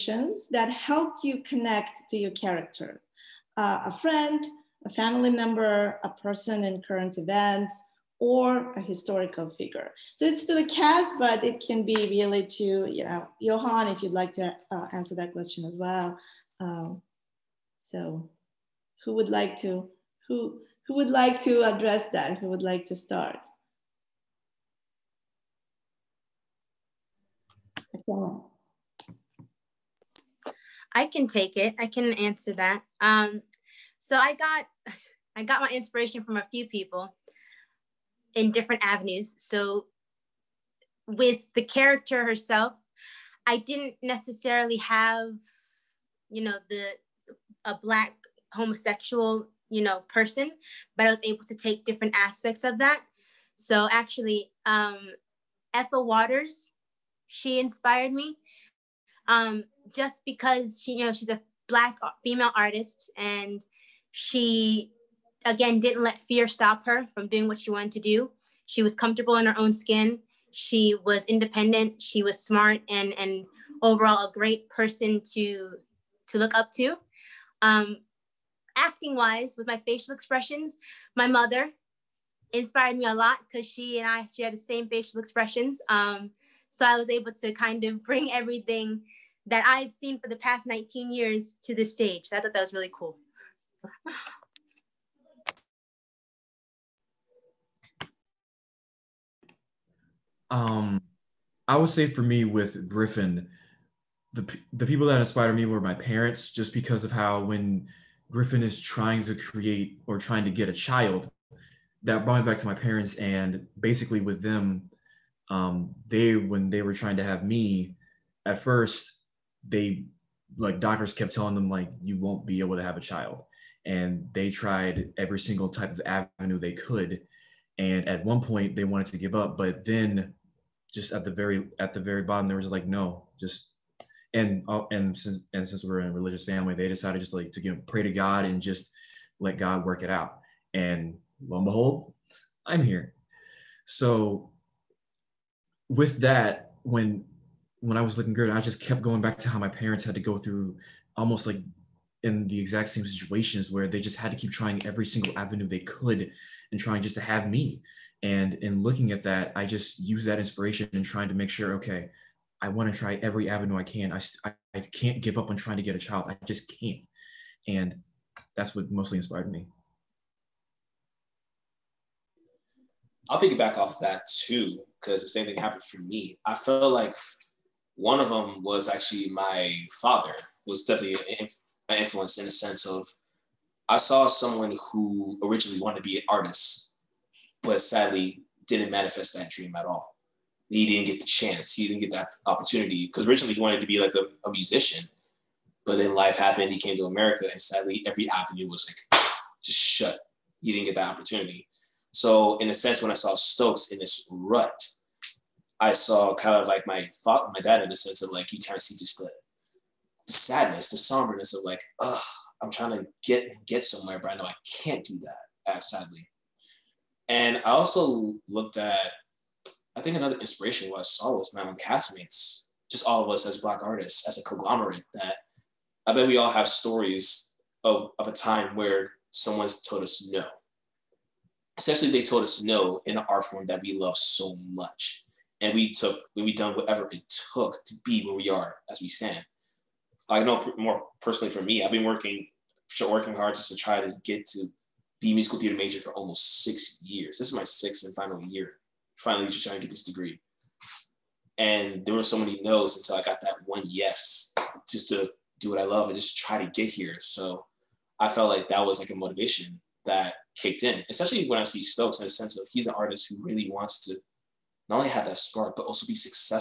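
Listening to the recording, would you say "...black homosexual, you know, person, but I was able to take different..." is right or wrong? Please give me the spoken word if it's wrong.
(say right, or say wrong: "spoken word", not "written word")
right.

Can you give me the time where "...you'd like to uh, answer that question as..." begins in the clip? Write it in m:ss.
0:14.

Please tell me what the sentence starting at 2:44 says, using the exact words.
I, I, I can't give up on trying to get a child.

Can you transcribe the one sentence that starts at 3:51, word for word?
Essentially, they told us no in an art form that we love so much.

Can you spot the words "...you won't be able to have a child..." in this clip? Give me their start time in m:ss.
2:02.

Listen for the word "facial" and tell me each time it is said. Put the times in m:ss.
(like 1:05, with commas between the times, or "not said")
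1:19, 1:24.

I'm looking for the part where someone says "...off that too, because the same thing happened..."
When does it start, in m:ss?
2:53.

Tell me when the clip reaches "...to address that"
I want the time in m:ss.
0:21.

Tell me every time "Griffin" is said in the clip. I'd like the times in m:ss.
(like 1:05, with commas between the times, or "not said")
1:42, 1:48.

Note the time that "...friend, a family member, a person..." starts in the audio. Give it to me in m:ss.
0:03.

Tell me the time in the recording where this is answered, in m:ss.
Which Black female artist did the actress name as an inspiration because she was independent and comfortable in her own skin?
0:55.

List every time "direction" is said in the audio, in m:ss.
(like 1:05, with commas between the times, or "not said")
not said.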